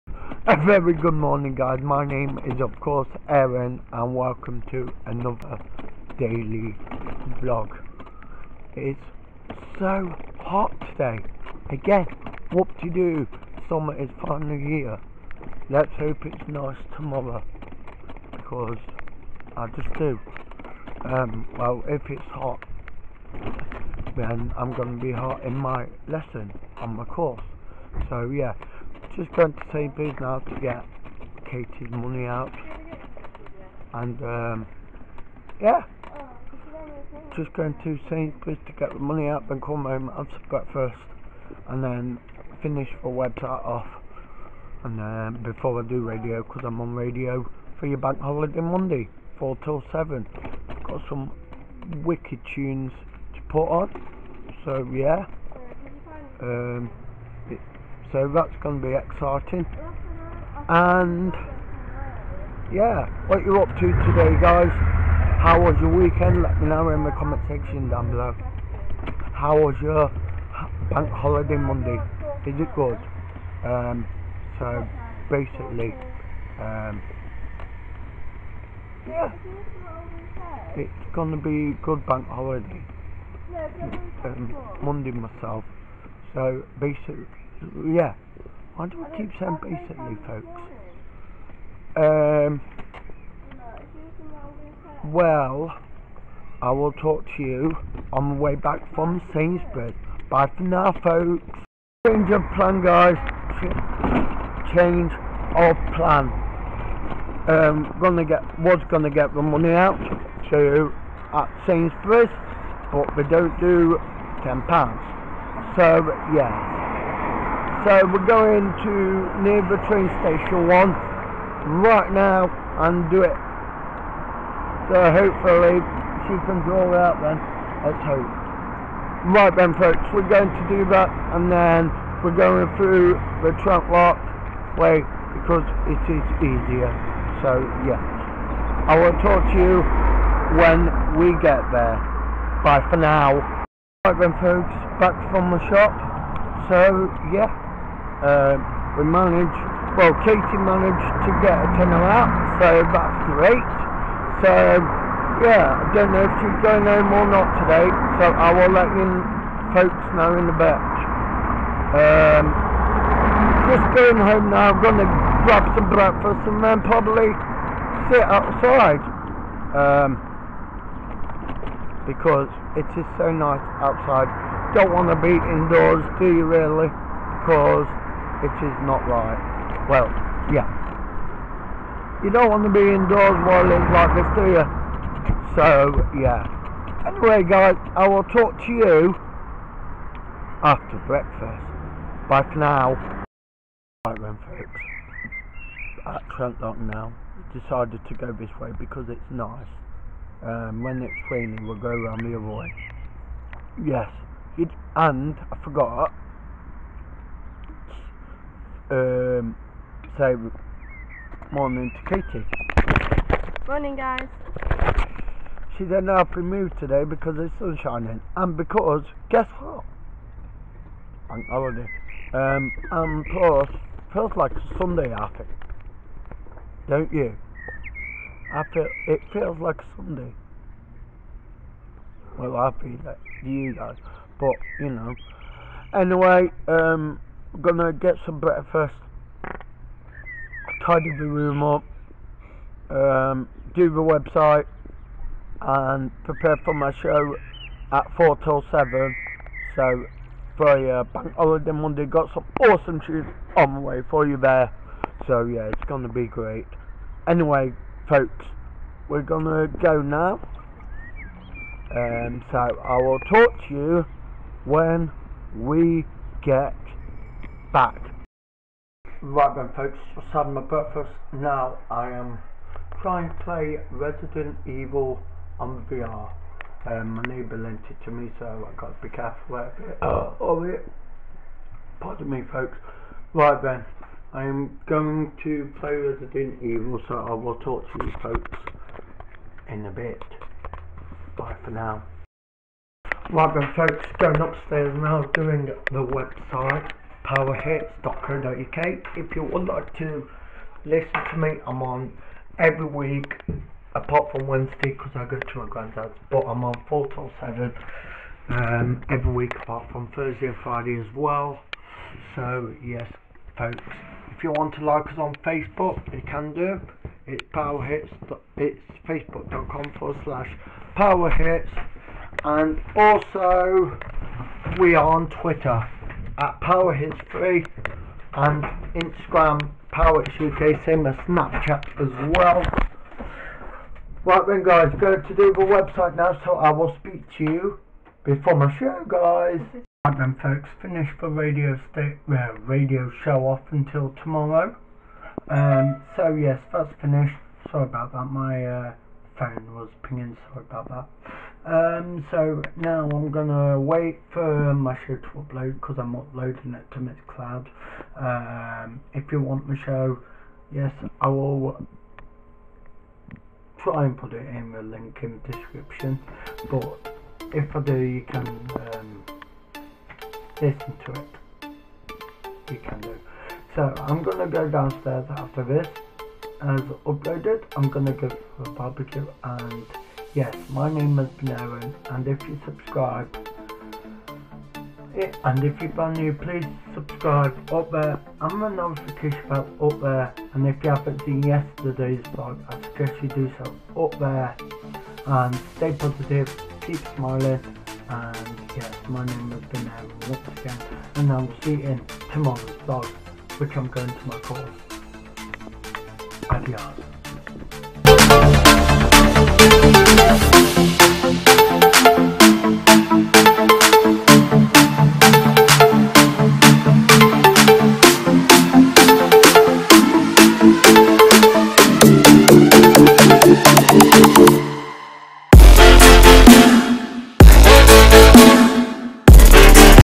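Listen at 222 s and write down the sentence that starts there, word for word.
Um, and plus, feels like Sunday.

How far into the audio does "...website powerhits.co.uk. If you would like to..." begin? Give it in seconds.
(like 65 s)
296 s.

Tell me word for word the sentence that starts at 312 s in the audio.
So, yes, folks, if you want to like us on Facebook, you can do.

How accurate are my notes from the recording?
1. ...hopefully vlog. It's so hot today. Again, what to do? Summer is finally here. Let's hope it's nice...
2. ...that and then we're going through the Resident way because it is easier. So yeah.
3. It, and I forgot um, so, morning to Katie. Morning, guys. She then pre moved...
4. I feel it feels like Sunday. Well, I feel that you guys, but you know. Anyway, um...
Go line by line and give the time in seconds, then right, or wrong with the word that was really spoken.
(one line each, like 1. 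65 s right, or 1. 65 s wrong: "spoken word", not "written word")
1. 6 s wrong: "daily", not "hopefully"
2. 130 s wrong: "Trentlock", not "Resident"
3. 204 s right
4. 228 s right.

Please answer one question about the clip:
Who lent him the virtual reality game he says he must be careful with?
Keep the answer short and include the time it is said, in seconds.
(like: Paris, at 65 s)
my neighbour, at 277 s.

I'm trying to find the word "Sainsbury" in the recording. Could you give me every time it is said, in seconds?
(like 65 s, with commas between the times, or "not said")
29 s, 38 s, 99 s, 111 s.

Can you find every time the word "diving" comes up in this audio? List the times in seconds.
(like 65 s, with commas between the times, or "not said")
not said.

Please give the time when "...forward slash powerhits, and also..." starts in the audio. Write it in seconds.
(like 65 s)
319 s.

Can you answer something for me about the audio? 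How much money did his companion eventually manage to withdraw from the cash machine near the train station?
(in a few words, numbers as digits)
a tenner.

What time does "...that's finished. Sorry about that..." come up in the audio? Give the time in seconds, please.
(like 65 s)
346 s.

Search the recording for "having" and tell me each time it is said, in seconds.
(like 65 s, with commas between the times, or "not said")
270 s.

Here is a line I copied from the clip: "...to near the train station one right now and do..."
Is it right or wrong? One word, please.
right.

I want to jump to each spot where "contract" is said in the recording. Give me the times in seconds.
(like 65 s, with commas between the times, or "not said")
not said.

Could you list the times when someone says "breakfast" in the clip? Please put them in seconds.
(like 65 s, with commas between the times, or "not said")
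40 s, 165 s, 191 s, 238 s, 270 s.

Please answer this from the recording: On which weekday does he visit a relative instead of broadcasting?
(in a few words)
Wednesday.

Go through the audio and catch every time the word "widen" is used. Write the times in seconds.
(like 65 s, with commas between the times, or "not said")
not said.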